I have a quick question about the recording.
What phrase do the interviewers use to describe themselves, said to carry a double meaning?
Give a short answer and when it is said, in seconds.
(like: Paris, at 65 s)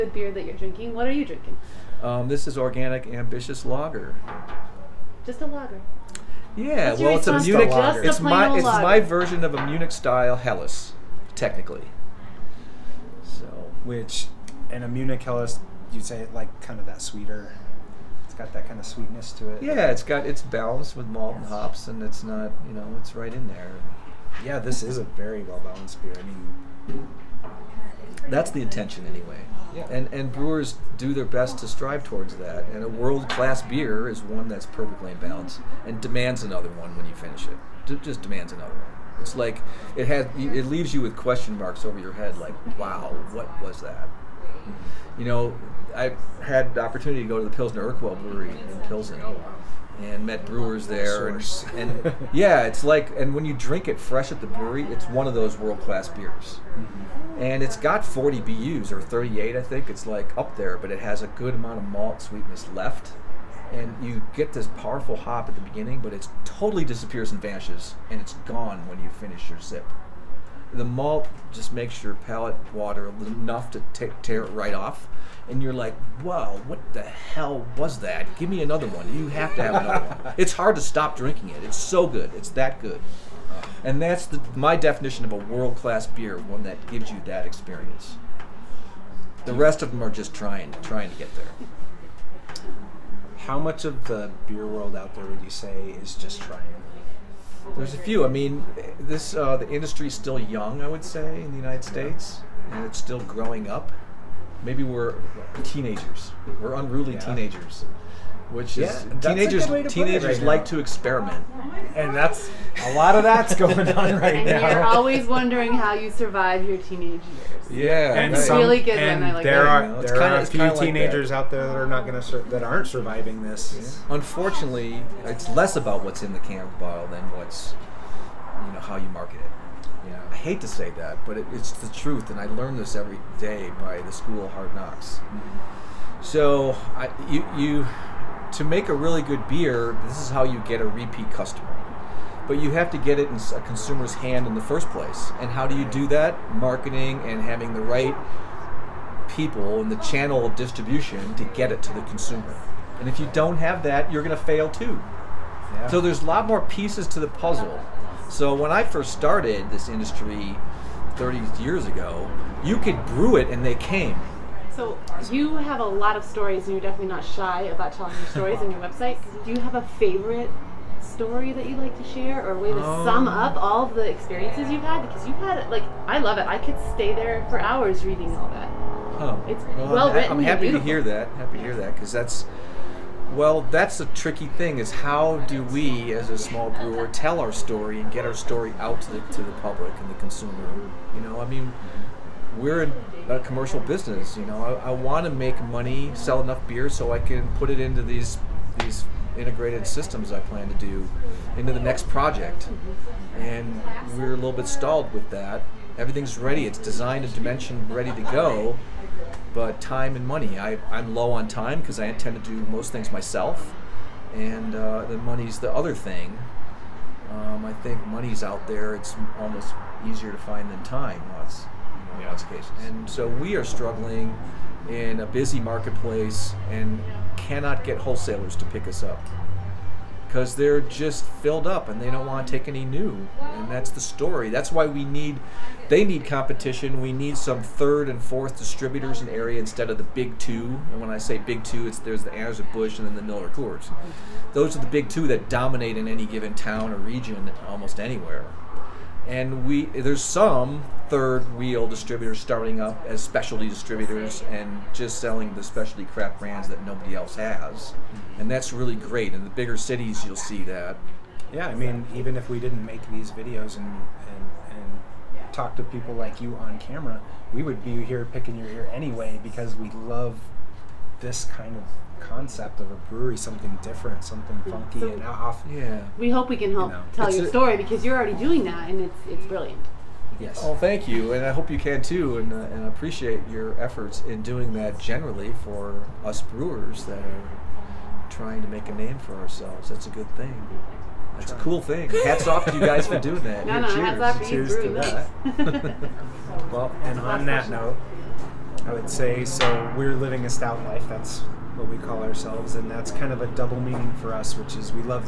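Stout life, at 300 s.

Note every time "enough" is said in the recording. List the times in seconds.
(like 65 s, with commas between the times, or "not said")
73 s, 196 s.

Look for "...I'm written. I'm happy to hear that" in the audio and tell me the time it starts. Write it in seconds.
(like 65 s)
180 s.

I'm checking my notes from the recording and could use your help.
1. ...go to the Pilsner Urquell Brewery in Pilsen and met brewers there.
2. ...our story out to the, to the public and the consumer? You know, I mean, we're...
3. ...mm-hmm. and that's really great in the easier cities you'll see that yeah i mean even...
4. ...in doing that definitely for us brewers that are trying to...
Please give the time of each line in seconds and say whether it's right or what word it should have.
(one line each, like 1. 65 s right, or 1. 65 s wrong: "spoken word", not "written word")
1. 47 s right
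2. 188 s right
3. 257 s wrong: "bigger", not "easier"
4. 284 s wrong: "generally", not "definitely".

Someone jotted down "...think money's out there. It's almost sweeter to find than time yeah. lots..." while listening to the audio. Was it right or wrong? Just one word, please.
wrong.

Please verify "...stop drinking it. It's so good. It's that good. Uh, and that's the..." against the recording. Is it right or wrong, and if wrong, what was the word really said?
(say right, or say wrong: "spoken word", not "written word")
right.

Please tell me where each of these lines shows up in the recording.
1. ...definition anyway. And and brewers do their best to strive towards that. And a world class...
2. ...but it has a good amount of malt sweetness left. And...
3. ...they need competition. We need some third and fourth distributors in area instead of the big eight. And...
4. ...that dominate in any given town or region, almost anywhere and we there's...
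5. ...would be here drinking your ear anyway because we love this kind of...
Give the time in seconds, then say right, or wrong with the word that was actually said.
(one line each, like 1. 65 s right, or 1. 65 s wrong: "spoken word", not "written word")
1. 28 s wrong: "intention", not "definition"
2. 60 s right
3. 235 s wrong: "two", not "eight"
4. 245 s right
5. 267 s wrong: "picking", not "drinking".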